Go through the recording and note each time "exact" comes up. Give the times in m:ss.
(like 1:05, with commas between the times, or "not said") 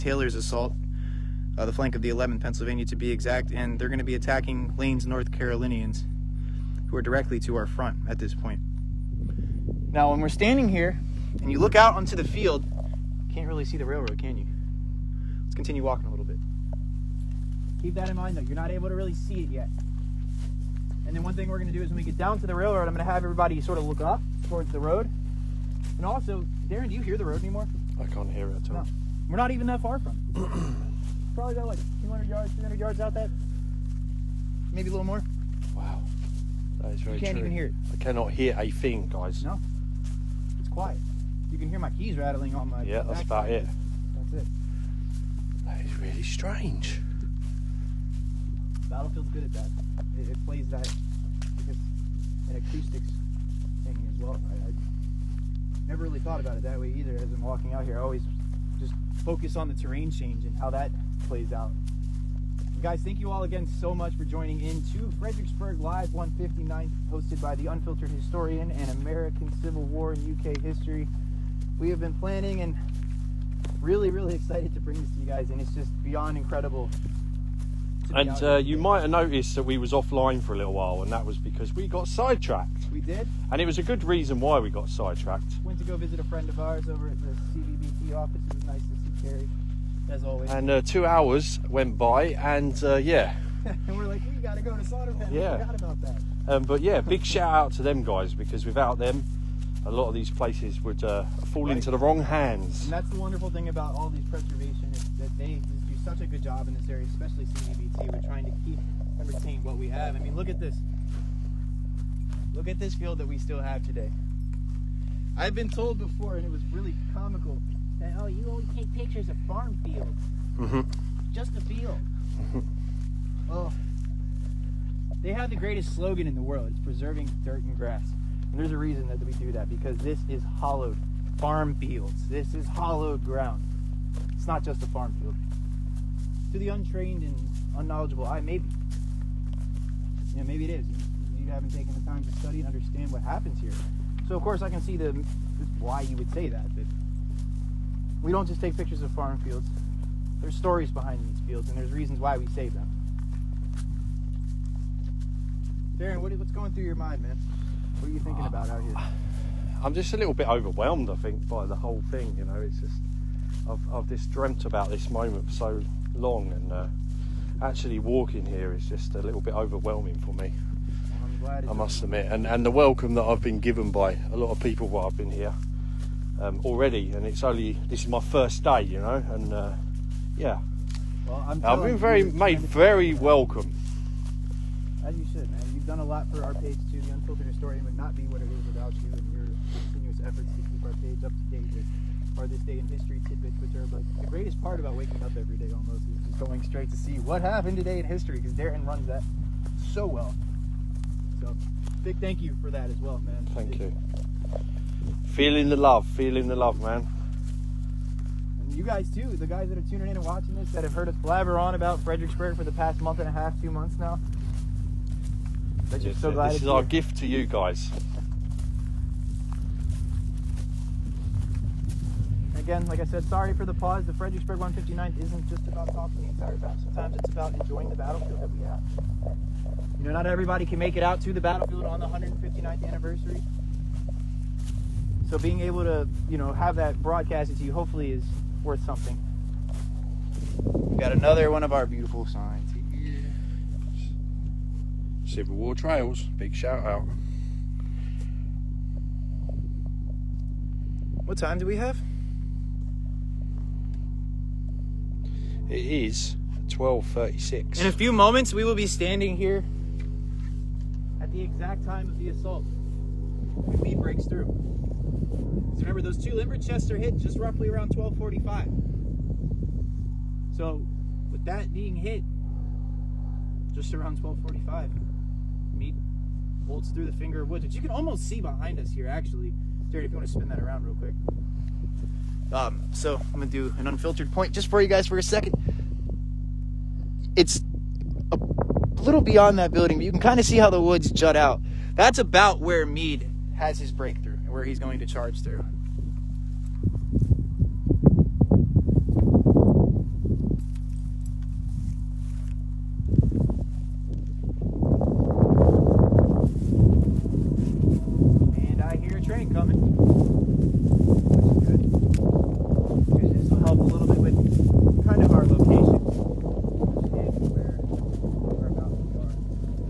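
0:03, 4:21.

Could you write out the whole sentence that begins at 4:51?
That's about where Meade has his breakthrough and where he's going to charge through.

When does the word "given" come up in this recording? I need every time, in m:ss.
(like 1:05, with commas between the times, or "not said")
2:53.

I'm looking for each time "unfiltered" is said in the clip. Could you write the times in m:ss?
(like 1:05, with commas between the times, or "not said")
1:07, 3:07, 4:43.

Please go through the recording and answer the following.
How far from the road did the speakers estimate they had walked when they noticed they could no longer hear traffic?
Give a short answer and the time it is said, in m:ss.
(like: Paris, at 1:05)
200 to 300 yards, at 0:32.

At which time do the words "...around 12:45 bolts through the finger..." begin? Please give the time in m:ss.
4:33.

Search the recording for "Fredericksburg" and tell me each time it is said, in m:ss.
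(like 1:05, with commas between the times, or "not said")
1:05, 3:32, 3:44.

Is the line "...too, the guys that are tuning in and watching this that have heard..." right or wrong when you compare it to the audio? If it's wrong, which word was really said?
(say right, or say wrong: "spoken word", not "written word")
right.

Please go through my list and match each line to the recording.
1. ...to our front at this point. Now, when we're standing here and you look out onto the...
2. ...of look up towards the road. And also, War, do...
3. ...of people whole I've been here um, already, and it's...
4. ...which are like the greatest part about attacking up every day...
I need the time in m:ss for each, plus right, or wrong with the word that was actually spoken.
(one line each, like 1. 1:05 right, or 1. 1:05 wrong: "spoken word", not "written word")
1. 0:07 right
2. 0:23 wrong: "Darren", not "War"
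3. 2:54 wrong: "while", not "whole"
4. 3:13 wrong: "waking", not "attacking".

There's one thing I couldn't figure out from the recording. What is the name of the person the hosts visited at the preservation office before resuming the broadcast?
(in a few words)
Terry.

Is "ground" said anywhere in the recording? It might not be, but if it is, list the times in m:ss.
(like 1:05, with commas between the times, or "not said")
2:13.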